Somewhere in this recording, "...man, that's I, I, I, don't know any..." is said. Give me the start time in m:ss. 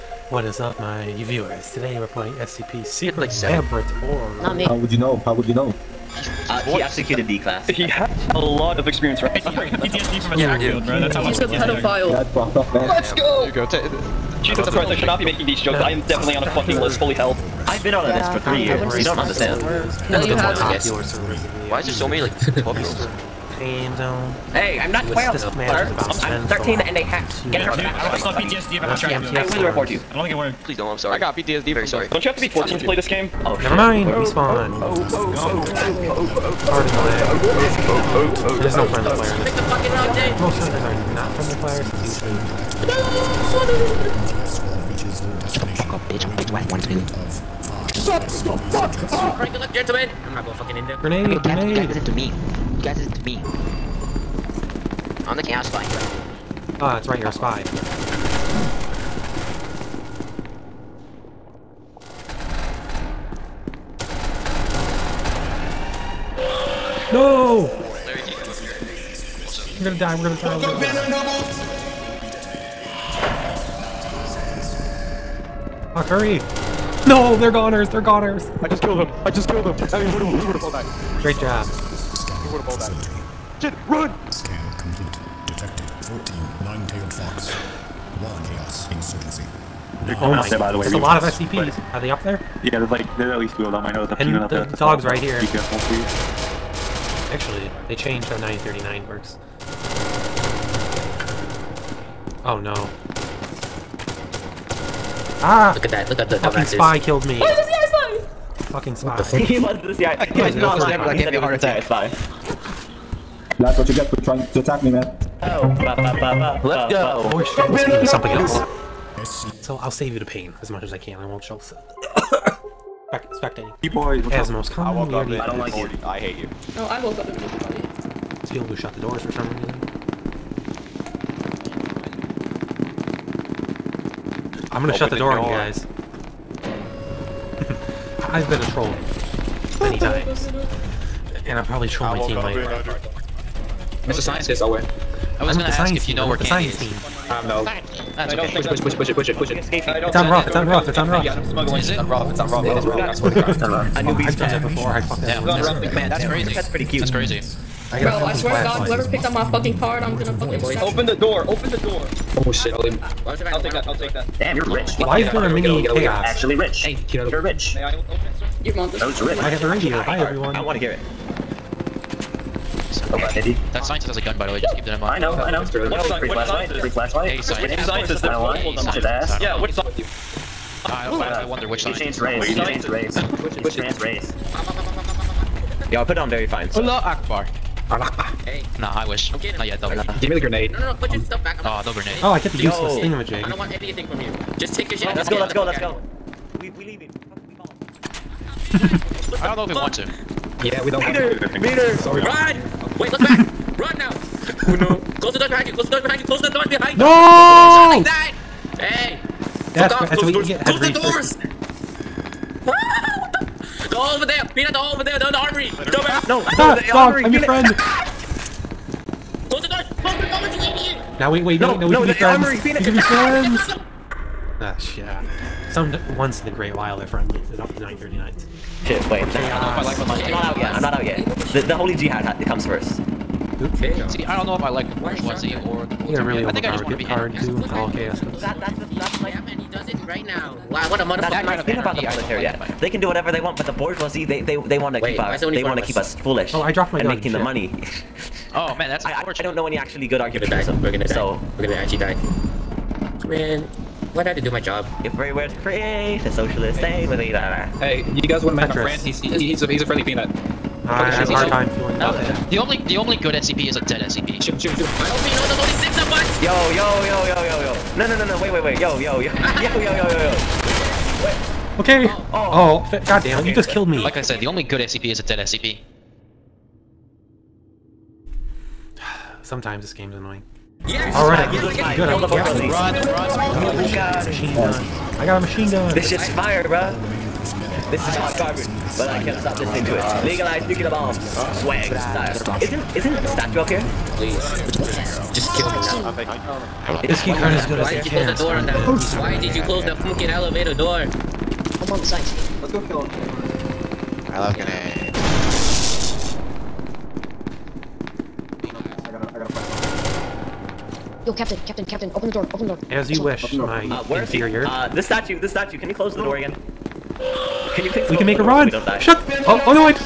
4:08.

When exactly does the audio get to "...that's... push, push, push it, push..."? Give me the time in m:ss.
2:28.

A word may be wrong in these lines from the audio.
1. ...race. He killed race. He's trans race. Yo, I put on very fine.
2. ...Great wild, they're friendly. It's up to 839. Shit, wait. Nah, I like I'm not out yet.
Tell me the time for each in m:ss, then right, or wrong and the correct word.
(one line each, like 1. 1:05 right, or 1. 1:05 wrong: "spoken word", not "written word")
1. 3:02 wrong: "changed", not "killed"
2. 3:46 wrong: "939", not "839".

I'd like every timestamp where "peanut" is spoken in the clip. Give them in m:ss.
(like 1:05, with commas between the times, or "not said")
1:34, 3:34, 3:42, 4:20.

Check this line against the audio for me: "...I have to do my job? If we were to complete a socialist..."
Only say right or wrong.
wrong.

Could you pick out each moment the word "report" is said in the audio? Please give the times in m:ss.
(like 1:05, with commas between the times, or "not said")
0:29.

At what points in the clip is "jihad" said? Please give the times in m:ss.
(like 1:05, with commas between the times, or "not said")
3:51.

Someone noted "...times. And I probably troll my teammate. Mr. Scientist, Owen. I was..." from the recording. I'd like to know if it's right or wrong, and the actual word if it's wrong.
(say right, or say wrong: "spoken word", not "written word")
right.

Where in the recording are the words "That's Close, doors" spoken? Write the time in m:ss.
3:30.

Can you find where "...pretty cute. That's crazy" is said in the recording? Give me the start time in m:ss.
2:36.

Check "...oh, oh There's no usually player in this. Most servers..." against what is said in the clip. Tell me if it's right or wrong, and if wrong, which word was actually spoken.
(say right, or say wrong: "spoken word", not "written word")
wrong: "friendly", not "usually".